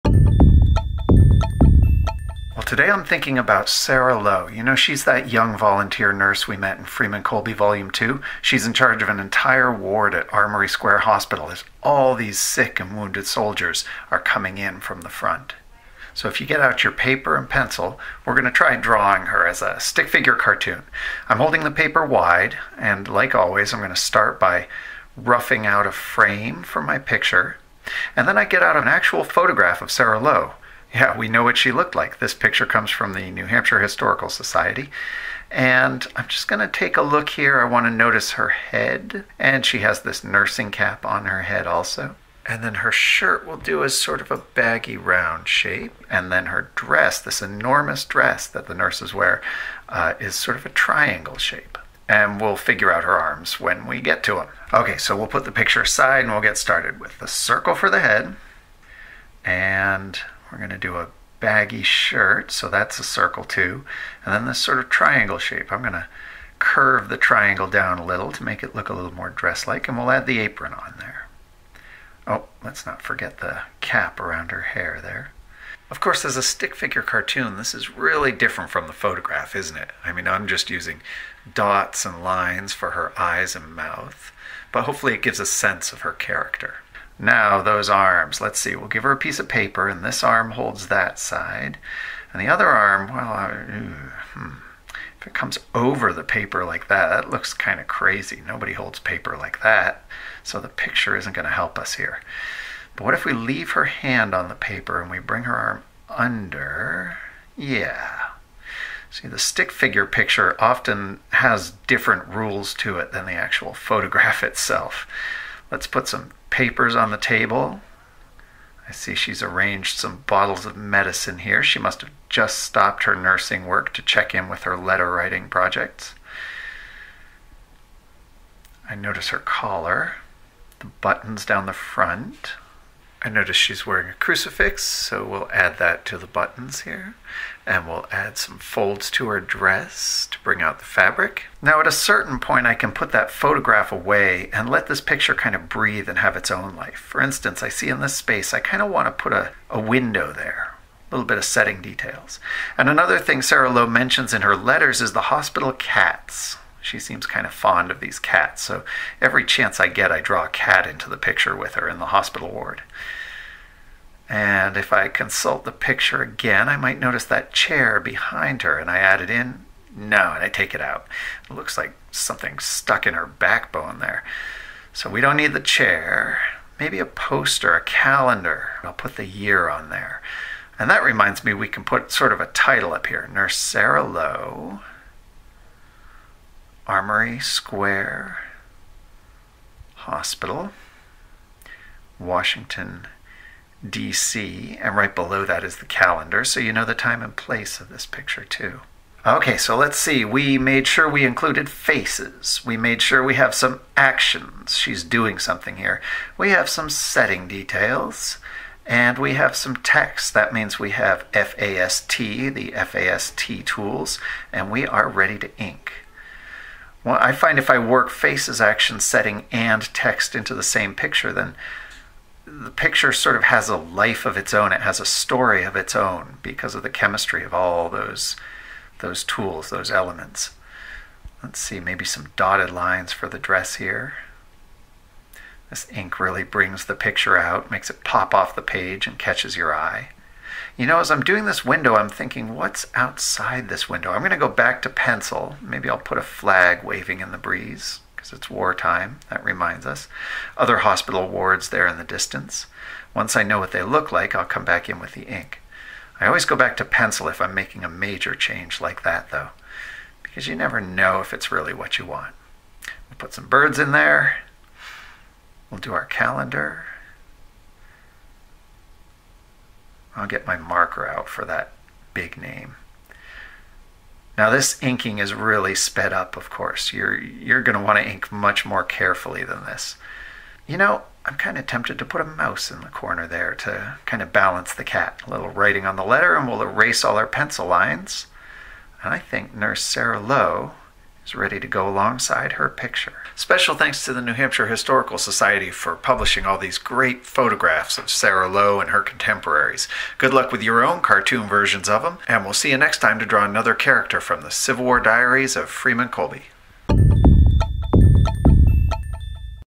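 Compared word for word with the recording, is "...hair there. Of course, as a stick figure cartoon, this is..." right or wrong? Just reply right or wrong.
right.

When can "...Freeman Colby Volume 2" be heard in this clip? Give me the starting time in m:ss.
0:06.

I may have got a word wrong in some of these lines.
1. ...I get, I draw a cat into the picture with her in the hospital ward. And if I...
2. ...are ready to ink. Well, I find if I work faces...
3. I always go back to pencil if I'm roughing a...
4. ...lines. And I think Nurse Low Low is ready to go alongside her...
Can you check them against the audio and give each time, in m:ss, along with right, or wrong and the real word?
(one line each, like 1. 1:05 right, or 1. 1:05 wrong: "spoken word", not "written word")
1. 2:39 right
2. 3:34 right
3. 4:16 wrong: "making", not "roughing"
4. 4:47 wrong: "Sarah", not "Low".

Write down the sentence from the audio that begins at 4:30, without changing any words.
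I'll get my marker out for that big name.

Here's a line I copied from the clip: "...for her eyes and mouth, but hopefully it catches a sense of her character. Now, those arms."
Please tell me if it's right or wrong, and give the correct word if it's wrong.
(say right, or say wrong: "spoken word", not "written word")
wrong: "gives", not "catches".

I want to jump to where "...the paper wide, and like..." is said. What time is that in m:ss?
0:21.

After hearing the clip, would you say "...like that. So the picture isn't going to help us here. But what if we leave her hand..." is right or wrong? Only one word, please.
right.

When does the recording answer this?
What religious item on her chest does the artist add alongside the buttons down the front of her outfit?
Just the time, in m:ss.
2:14.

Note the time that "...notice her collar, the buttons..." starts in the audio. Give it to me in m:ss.
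2:08.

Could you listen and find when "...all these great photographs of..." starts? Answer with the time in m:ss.
4:56.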